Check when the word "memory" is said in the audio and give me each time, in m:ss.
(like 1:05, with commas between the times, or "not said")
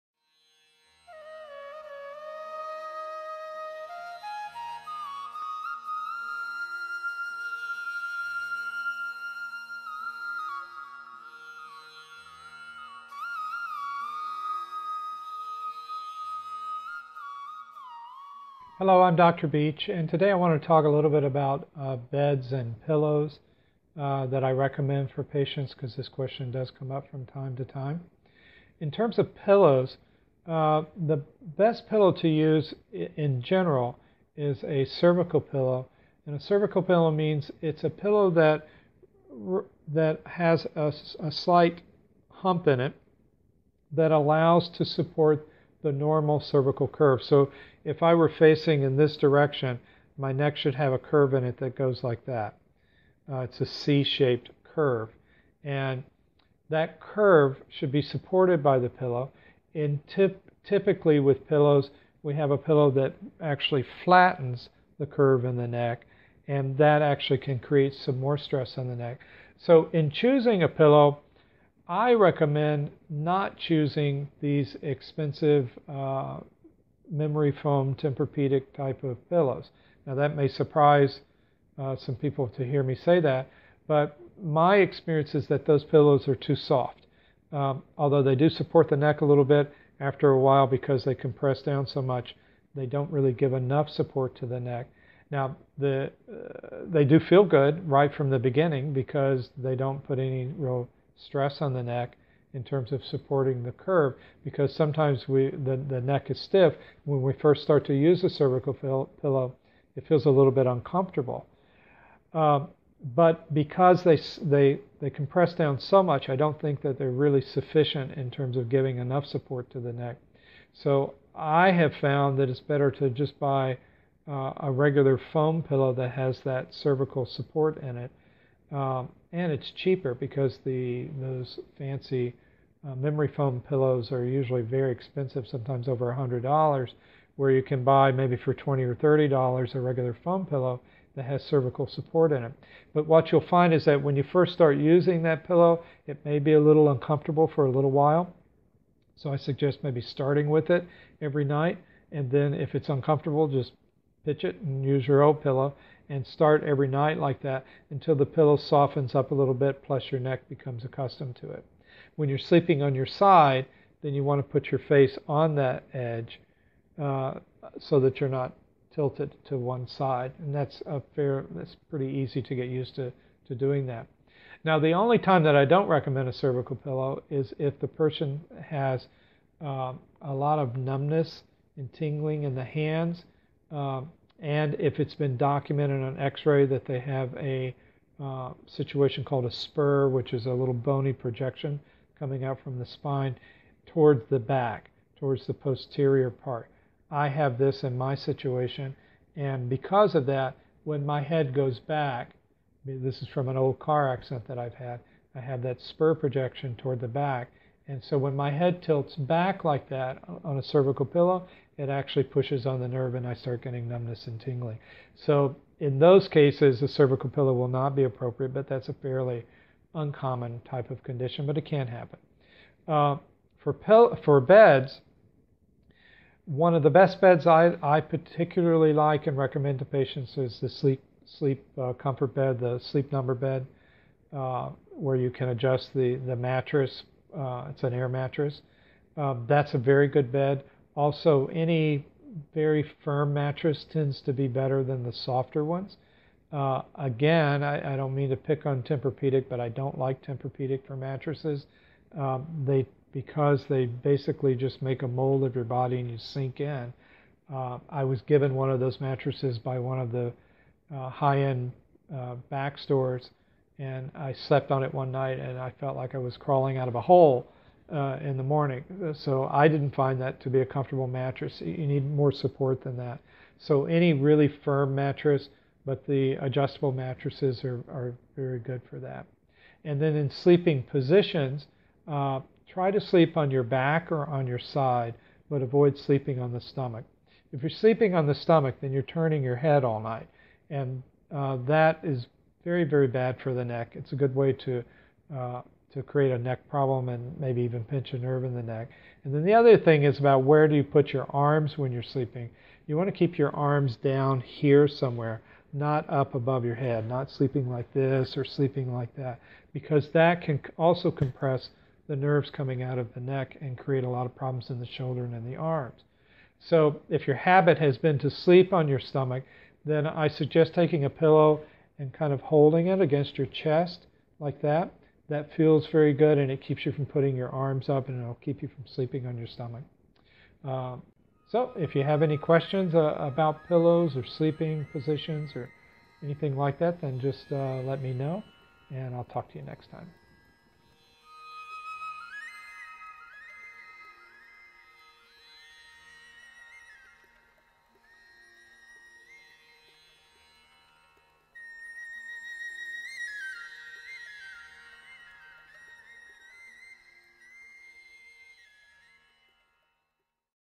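1:17, 2:12.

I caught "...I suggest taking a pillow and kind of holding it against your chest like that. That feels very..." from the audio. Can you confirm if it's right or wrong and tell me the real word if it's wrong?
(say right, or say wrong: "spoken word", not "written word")
right.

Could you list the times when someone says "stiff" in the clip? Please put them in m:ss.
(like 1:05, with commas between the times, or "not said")
1:46.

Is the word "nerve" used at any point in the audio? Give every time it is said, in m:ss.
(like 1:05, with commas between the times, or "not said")
3:32, 4:58, 5:12.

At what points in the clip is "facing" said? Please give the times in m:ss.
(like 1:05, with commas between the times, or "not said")
0:48.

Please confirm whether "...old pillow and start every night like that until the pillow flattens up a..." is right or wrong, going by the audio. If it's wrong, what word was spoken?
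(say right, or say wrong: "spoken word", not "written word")
wrong: "softens", not "flattens".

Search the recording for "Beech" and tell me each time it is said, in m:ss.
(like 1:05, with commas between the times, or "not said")
0:19.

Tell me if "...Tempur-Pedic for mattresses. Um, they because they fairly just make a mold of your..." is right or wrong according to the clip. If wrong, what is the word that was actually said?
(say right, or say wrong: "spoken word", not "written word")
wrong: "basically", not "fairly".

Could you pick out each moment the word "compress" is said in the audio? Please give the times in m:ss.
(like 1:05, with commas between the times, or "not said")
1:31, 1:55, 5:11.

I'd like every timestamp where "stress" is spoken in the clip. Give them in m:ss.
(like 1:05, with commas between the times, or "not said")
1:08, 1:41.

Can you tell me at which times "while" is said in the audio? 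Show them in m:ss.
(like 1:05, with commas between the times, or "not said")
1:30, 2:27.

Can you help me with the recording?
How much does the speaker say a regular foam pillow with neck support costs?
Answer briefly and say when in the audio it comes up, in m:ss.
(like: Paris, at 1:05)
$20 or $30, at 2:18.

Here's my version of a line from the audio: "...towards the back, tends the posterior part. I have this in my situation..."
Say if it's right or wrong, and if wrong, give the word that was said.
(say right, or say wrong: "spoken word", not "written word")
wrong: "towards", not "tends".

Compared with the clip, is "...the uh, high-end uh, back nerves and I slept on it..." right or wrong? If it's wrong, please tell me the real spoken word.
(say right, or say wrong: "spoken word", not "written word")
wrong: "stores", not "nerves".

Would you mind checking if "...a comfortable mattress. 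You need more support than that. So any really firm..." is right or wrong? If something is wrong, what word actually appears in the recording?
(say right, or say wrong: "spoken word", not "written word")
right.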